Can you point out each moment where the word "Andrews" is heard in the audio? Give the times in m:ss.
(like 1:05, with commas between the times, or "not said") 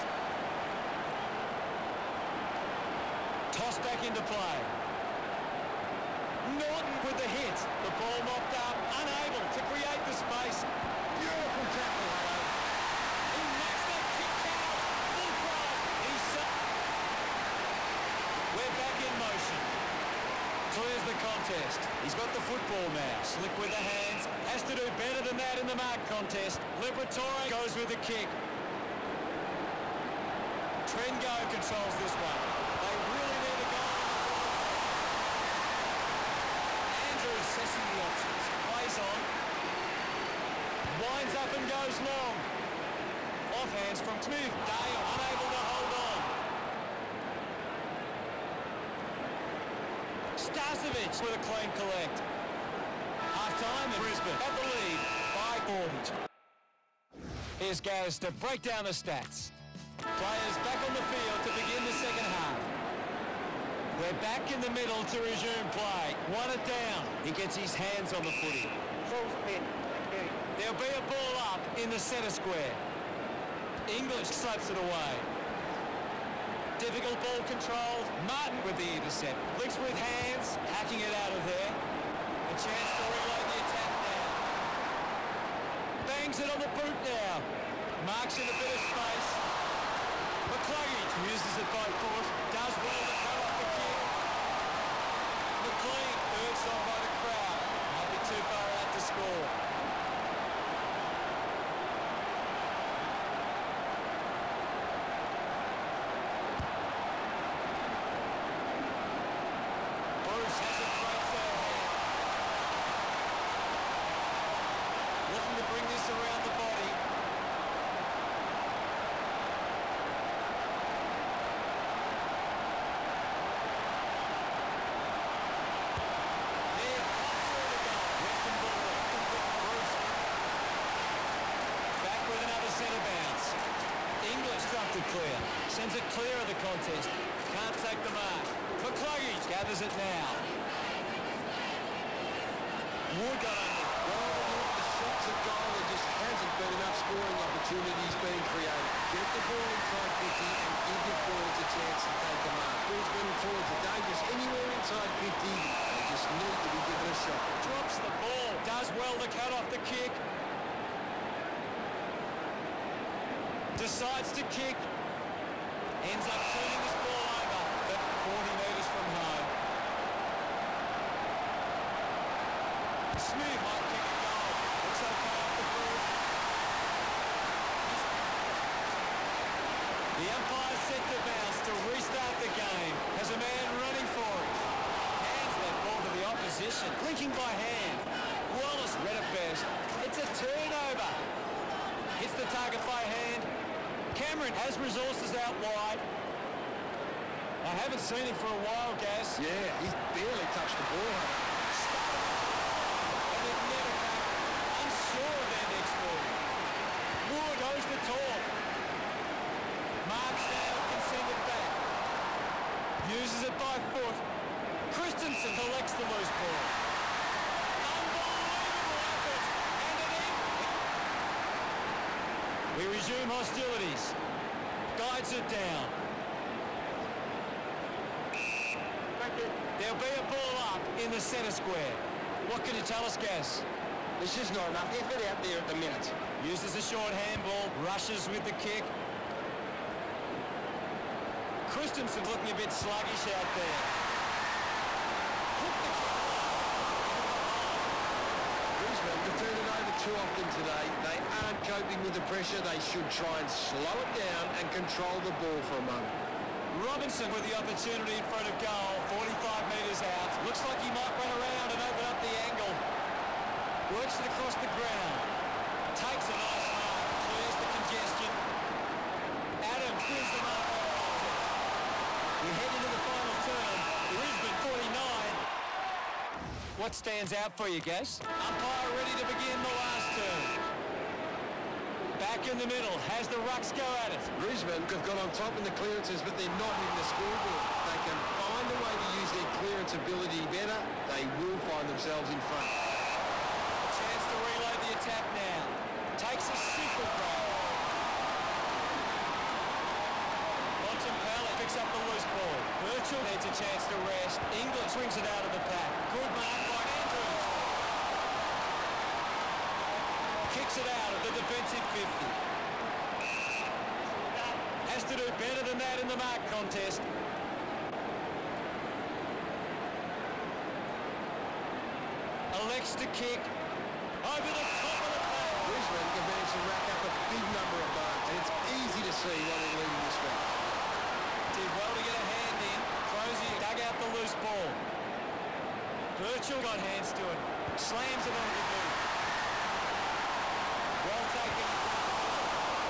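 0:37, 5:06.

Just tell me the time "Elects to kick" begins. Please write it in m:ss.
5:22.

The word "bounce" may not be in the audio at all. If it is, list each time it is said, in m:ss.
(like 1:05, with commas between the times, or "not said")
2:13, 3:01.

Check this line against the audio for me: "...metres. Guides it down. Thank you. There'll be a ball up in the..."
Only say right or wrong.
wrong.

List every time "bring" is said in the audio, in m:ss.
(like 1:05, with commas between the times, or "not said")
1:55, 5:04.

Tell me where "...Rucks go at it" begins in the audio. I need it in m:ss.
4:43.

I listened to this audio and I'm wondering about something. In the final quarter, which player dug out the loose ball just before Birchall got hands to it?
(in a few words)
Crozier.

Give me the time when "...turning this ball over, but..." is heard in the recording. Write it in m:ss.
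2:46.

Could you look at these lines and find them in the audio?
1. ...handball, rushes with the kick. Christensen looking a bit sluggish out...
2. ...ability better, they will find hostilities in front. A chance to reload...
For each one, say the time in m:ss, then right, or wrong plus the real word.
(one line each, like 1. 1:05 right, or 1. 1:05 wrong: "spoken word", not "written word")
1. 3:57 right
2. 4:49 wrong: "themselves", not "hostilities".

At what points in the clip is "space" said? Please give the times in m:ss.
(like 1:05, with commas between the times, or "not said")
0:10, 1:28.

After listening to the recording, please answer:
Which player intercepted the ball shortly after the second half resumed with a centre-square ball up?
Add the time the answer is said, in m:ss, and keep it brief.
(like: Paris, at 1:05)
Martin, at 1:18.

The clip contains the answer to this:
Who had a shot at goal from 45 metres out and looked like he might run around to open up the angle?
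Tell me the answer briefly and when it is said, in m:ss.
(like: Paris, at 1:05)
Robinson, at 4:16.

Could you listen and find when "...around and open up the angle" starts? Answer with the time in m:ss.
4:21.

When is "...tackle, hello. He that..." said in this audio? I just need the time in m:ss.
0:11.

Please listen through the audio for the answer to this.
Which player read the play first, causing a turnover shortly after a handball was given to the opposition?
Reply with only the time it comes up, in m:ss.
3:08.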